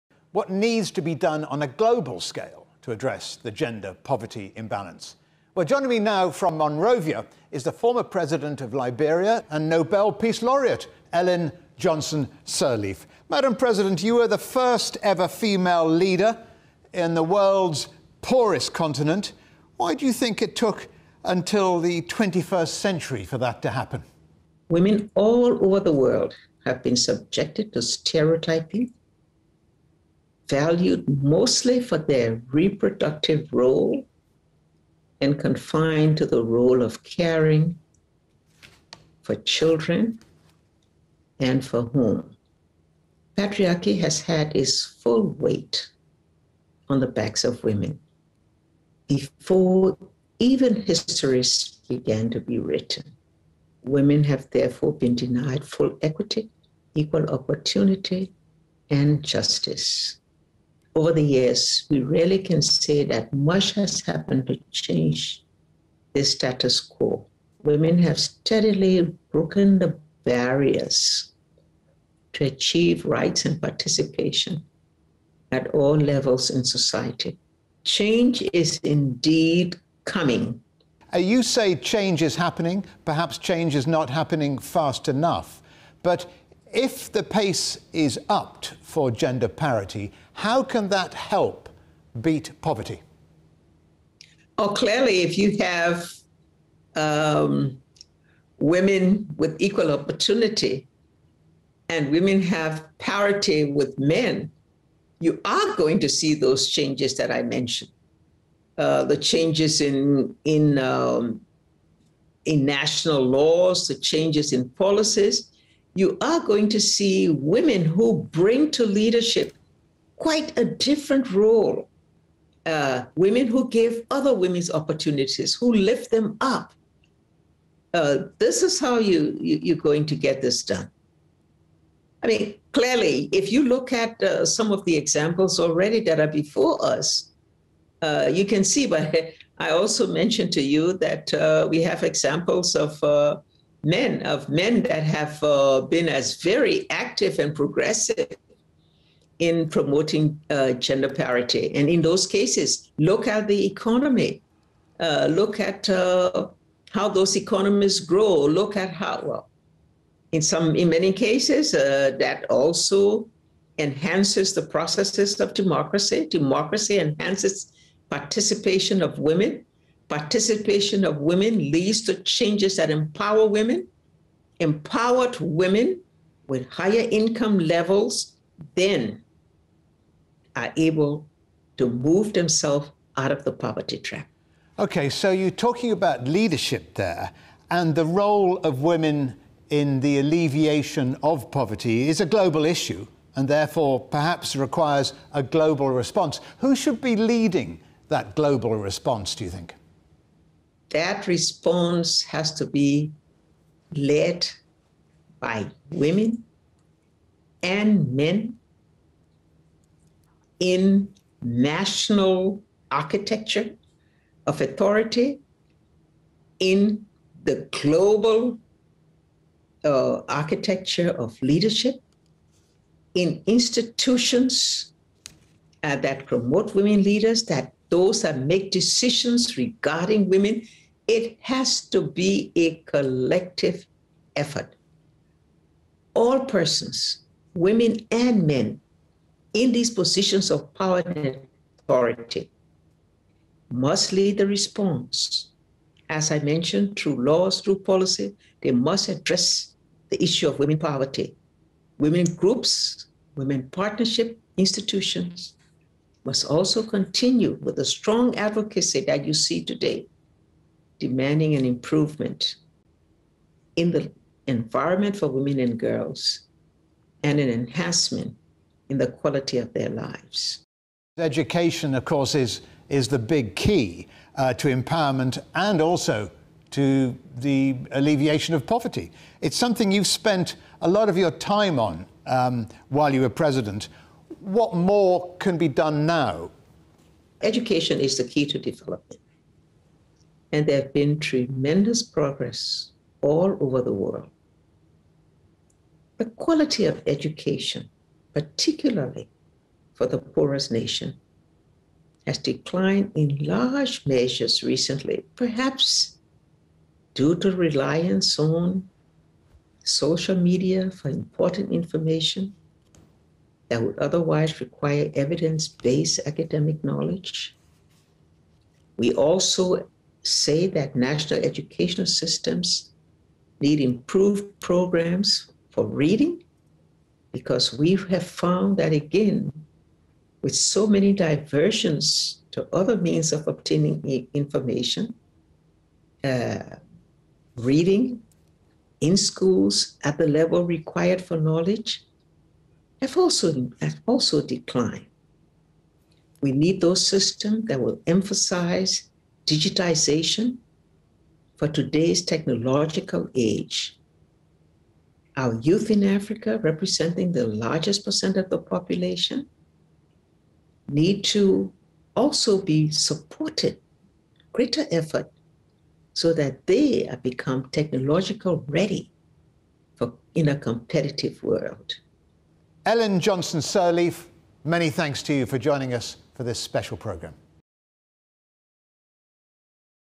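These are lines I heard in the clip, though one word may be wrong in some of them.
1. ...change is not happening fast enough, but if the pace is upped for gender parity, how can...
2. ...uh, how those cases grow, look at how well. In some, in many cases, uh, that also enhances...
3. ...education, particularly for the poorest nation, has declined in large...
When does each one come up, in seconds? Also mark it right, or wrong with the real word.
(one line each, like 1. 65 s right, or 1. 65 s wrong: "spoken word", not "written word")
1. 83 s right
2. 155 s wrong: "economies", not "cases"
3. 297 s right.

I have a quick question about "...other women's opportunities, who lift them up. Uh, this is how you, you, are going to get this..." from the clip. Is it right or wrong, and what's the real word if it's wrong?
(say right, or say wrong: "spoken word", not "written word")
right.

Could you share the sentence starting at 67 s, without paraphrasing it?
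Women have steadily broken the barriers to achieve rights and participation at all levels in society.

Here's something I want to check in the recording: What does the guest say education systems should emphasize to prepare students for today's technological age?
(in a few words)
Digitization.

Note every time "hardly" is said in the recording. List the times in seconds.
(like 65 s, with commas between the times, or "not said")
not said.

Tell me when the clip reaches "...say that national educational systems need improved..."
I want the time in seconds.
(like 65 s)
320 s.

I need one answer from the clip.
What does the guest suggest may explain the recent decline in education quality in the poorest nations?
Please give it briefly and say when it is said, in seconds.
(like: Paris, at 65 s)
Reliance on social media, at 307 s.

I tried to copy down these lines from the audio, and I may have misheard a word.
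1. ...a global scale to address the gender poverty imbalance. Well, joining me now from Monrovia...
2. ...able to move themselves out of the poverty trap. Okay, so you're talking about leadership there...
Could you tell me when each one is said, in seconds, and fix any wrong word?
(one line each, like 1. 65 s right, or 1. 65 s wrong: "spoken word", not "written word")
1. 1 s right
2. 180 s right.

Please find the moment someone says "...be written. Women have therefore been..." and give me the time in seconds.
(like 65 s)
52 s.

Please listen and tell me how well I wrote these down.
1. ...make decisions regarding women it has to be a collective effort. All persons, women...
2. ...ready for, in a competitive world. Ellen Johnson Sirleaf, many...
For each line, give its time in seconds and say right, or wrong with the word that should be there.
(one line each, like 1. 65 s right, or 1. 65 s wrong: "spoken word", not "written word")
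1. 228 s right
2. 368 s right.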